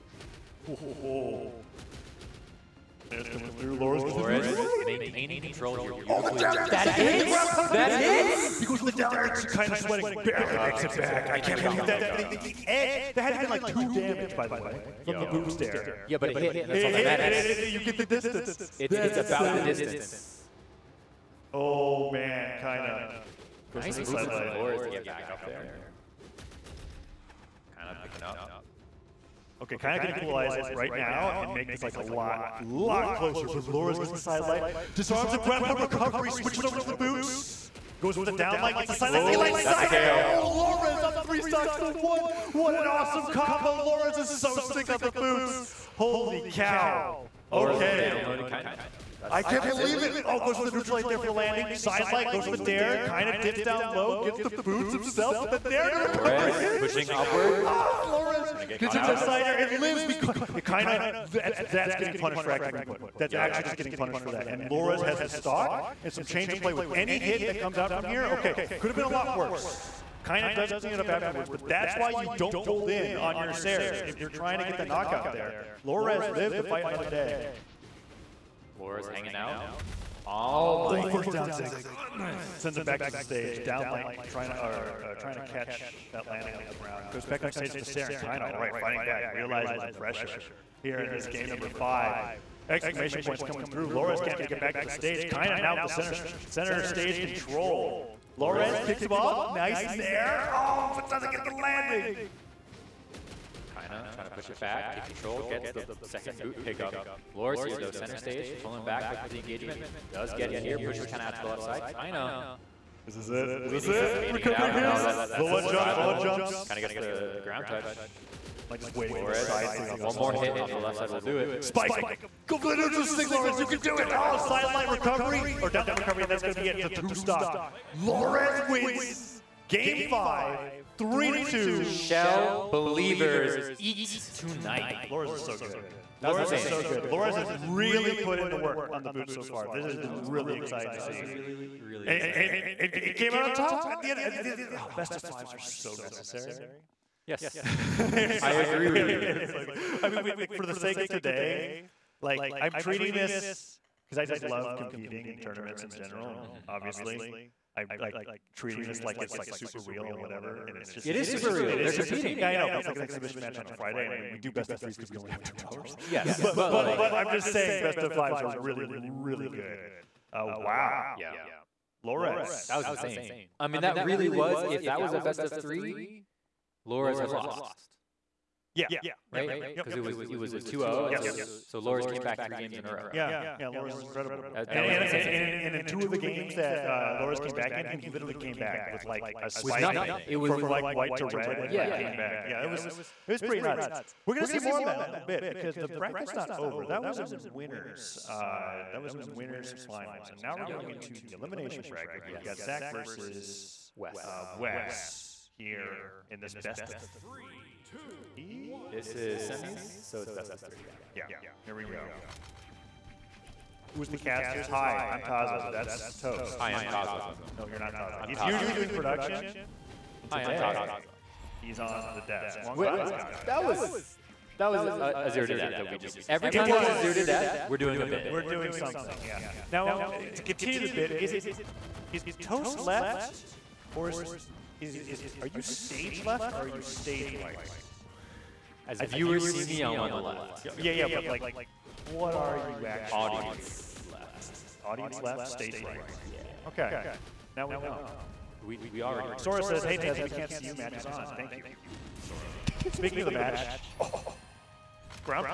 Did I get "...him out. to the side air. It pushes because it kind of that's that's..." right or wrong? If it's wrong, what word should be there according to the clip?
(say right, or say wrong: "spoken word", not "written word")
wrong: "lives", not "pushes".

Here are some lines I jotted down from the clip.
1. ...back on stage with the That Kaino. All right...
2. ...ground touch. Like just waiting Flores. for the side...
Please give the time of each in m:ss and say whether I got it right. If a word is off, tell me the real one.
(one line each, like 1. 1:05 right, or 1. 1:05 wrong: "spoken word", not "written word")
1. 1:27 wrong: "Saren", not "That"
2. 1:57 right.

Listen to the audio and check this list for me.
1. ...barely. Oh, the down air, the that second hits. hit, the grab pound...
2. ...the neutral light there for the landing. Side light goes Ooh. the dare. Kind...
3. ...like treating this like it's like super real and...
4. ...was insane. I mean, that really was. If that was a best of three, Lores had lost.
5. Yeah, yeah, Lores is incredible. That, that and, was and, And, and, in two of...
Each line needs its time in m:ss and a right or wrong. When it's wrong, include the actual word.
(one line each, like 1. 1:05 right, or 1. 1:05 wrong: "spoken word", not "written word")
1. 0:05 wrong: "beautifully", not "barely"
2. 0:50 right
3. 2:37 right
4. 2:52 right
5. 3:03 right.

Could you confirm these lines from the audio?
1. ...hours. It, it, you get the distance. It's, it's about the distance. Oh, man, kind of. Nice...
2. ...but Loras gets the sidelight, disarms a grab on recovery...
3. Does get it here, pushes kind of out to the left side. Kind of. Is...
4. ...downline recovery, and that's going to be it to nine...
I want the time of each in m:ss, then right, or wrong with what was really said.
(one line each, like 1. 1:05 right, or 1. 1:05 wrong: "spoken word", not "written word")
1. 0:17 wrong: "matters", not "hours"
2. 0:33 right
3. 1:50 right
4. 2:05 wrong: "two", not "nine".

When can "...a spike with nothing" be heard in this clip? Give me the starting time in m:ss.
3:09.